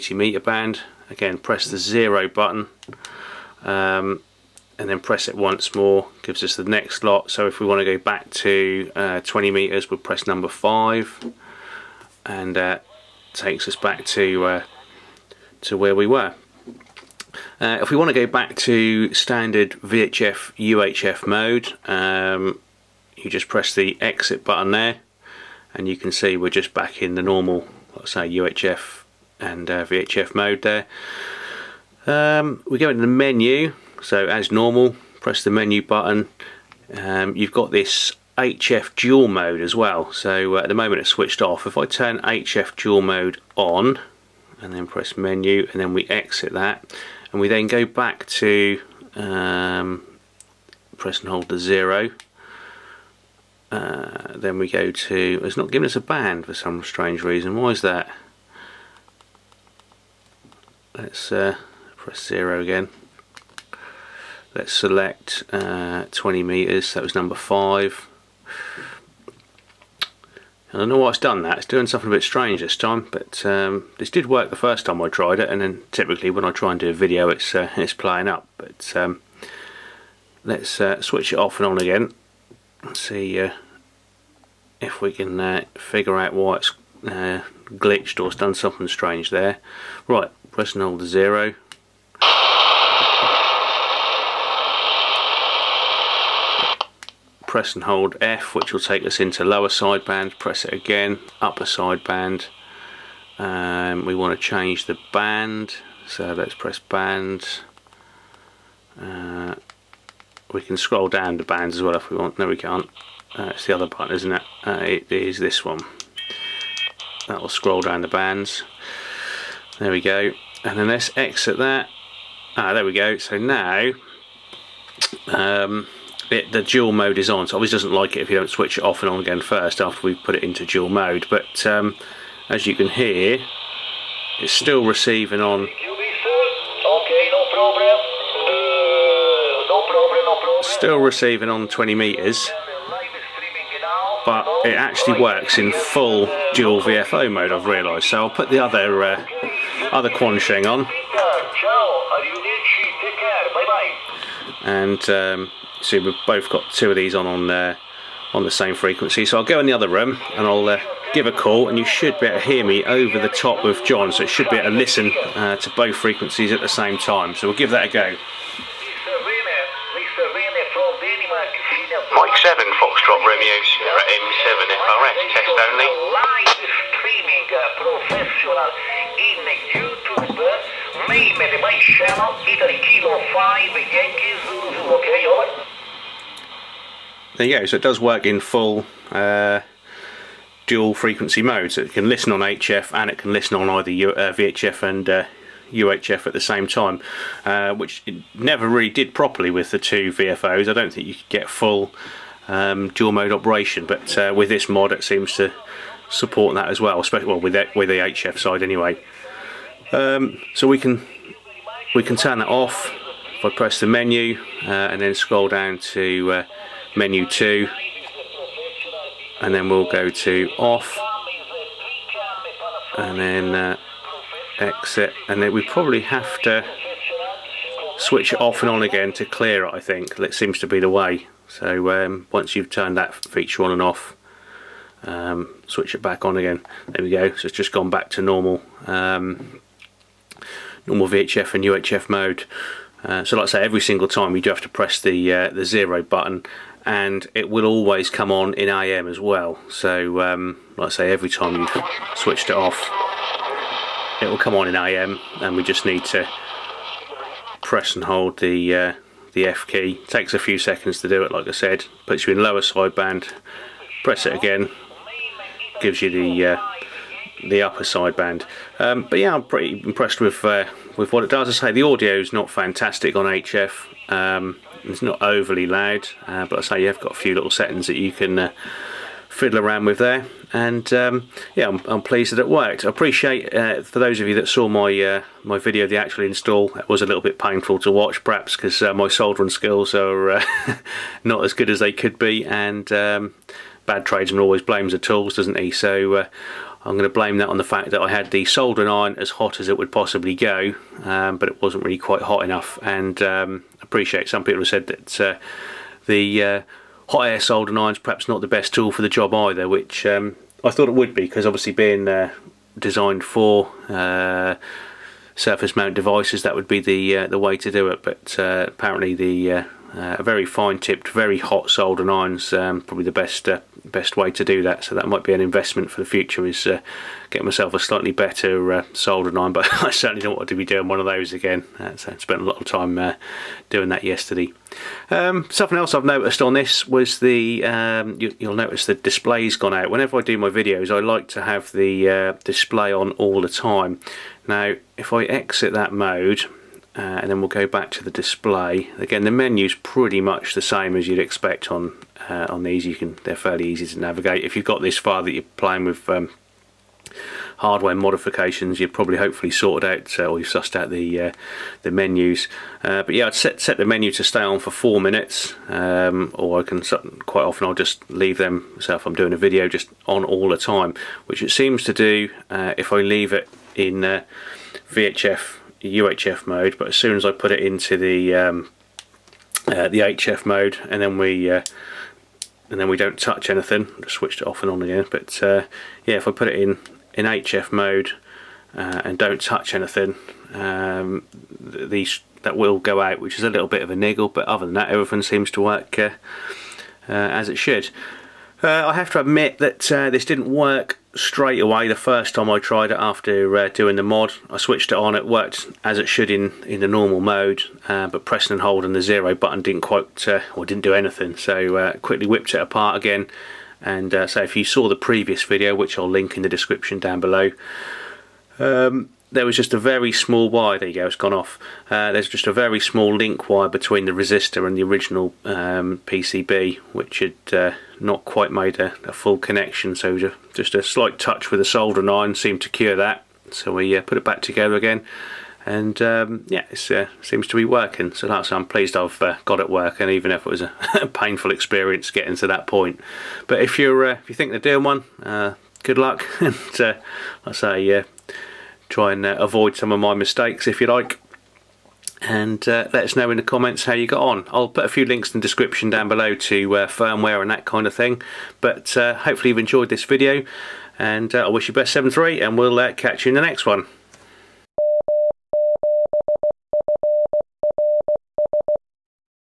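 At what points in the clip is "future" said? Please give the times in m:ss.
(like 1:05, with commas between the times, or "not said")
5:26.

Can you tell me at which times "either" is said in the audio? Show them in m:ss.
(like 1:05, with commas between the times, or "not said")
3:13, 5:09.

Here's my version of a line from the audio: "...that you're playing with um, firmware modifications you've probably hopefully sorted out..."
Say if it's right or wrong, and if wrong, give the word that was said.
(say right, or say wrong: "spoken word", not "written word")
wrong: "hardware", not "firmware".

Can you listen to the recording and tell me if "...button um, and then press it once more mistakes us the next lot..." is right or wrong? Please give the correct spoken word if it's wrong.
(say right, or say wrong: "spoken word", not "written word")
wrong: "gives", not "mistakes".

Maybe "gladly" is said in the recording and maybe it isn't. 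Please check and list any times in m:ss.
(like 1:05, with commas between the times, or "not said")
not said.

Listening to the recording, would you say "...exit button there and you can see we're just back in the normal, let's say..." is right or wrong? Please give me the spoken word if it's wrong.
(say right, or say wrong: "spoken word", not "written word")
right.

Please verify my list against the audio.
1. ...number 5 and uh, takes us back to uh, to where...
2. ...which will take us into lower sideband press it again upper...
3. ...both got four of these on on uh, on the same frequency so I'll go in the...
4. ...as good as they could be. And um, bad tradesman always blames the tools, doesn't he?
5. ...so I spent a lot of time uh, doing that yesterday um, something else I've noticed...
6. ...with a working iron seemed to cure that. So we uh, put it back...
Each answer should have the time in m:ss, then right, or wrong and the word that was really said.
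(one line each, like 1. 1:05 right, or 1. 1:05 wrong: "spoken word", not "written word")
1. 0:10 right
2. 1:38 right
3. 2:36 wrong: "two", not "four"
4. 4:51 right
5. 5:31 right
6. 7:11 wrong: "soldering", not "working".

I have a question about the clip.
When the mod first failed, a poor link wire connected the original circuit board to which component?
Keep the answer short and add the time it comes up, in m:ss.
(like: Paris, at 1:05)
resistor, at 7:04.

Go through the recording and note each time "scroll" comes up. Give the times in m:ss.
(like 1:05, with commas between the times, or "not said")
1:50, 1:57, 3:35.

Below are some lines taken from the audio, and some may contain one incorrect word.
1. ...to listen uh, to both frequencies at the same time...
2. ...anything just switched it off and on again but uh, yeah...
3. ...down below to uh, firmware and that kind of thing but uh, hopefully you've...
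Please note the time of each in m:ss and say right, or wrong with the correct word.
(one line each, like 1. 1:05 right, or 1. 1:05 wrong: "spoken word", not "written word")
1. 2:44 right
2. 6:23 right
3. 7:35 right.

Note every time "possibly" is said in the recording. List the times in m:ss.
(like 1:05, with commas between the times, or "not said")
4:59.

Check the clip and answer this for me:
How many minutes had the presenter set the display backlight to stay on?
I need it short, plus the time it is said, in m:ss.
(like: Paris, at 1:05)
4, at 6:04.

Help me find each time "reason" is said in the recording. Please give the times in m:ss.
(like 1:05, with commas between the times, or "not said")
0:57.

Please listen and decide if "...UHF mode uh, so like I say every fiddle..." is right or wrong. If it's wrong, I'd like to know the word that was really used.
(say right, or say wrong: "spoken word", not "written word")
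wrong: "single", not "fiddle".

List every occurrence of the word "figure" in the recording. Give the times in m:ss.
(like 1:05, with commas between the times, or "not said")
1:25.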